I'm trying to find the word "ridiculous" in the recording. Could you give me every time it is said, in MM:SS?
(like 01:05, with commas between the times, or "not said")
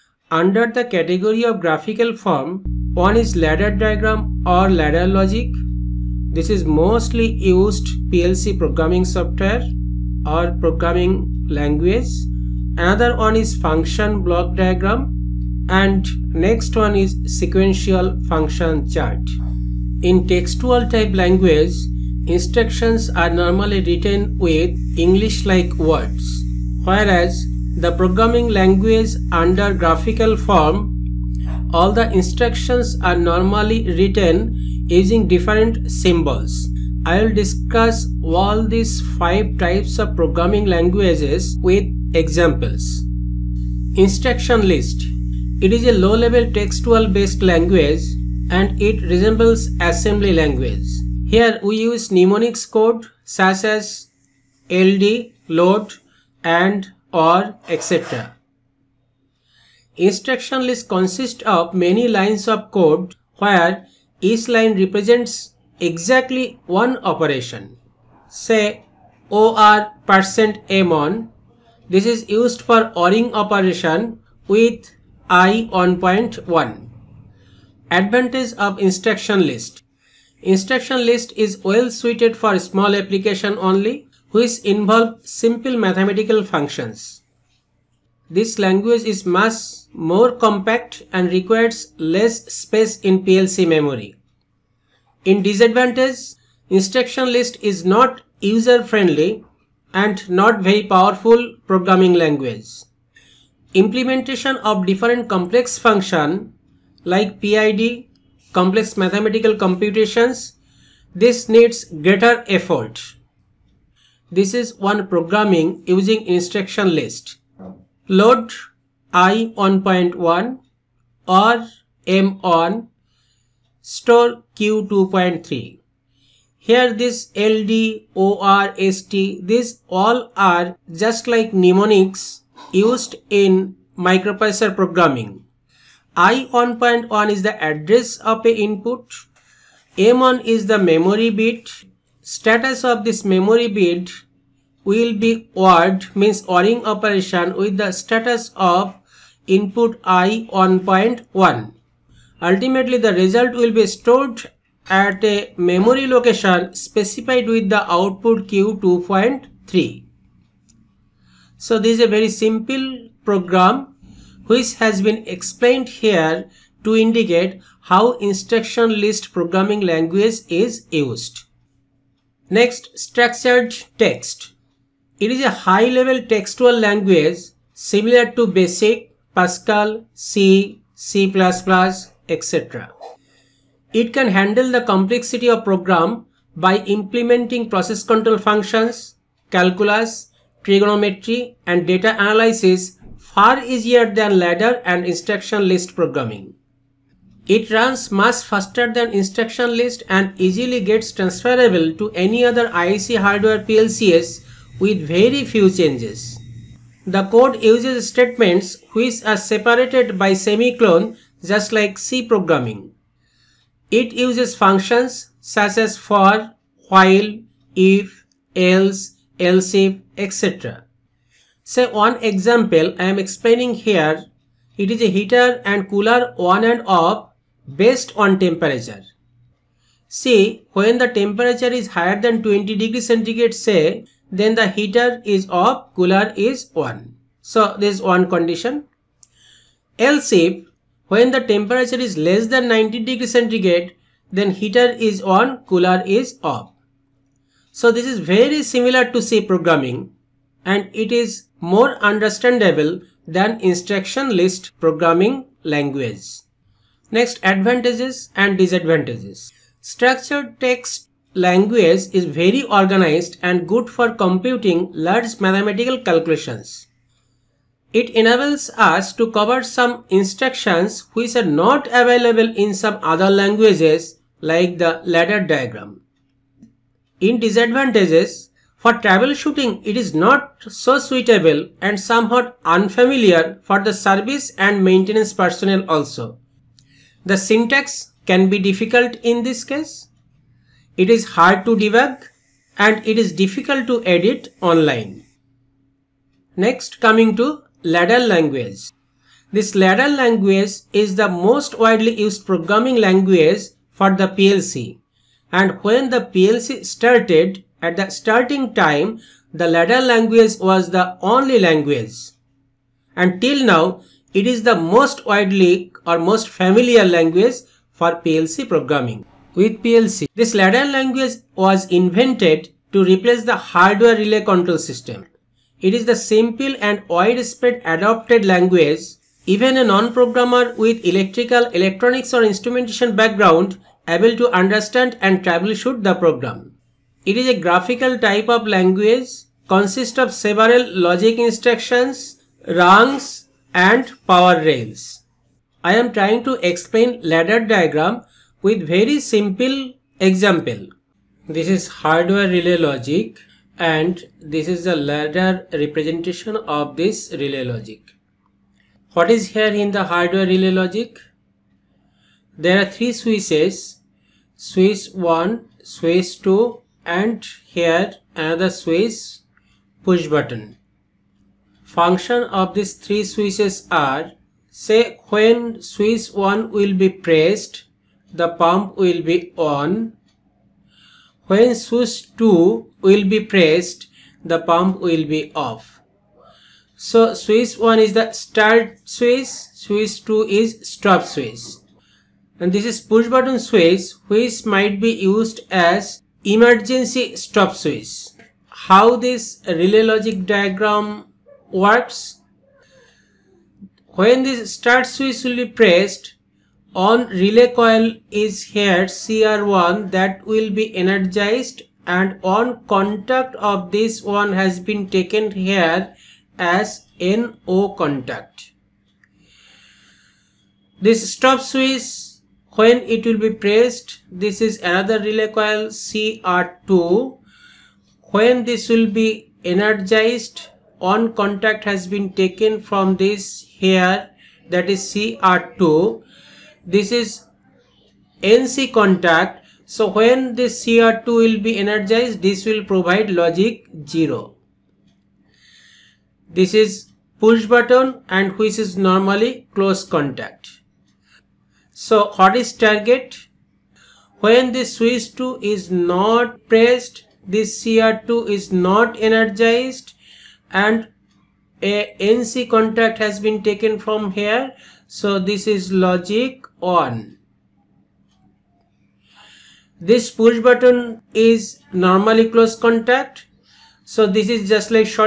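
not said.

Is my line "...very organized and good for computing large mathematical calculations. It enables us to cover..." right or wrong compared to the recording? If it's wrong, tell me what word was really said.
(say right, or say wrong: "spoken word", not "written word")
right.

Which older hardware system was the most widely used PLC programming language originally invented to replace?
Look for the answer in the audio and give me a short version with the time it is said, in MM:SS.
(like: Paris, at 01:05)
Hardware relay control system, at 05:23.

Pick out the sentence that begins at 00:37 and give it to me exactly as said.
I will discuss all these five types of programming languages with examples.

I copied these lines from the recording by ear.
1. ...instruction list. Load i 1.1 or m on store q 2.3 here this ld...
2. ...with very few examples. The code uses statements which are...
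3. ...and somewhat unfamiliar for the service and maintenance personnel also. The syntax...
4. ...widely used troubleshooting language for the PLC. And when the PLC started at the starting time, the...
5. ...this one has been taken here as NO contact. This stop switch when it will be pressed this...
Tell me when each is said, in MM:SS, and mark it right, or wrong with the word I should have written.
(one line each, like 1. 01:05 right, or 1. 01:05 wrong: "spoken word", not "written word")
1. 01:56 right
2. 03:24 wrong: "changes", not "examples"
3. 04:41 right
4. 05:01 wrong: "programming", not "troubleshooting"
5. 06:53 right.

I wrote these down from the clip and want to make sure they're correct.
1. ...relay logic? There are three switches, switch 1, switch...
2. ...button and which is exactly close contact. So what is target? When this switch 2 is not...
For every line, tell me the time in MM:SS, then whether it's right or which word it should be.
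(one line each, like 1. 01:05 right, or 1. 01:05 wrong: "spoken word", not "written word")
1. 06:00 right
2. 07:27 wrong: "normally", not "exactly".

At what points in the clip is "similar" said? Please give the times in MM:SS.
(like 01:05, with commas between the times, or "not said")
02:57, 04:08.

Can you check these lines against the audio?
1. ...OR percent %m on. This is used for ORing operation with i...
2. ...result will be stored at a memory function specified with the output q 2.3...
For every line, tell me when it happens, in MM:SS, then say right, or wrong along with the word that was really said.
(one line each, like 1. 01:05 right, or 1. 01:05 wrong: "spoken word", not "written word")
1. 01:09 right
2. 02:33 wrong: "location", not "function".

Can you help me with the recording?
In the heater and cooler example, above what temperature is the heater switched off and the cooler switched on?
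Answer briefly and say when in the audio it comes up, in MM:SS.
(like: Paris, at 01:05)
20 degrees centigrade, at 03:52.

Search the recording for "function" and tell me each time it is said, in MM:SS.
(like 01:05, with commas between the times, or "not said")
00:13, 00:18, 01:26, 01:45, 03:08, 03:34, 06:11.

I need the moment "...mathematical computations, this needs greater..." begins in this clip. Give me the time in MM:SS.
01:48.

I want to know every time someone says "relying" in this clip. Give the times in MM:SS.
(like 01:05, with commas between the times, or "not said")
not said.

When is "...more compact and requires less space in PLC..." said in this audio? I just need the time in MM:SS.
01:29.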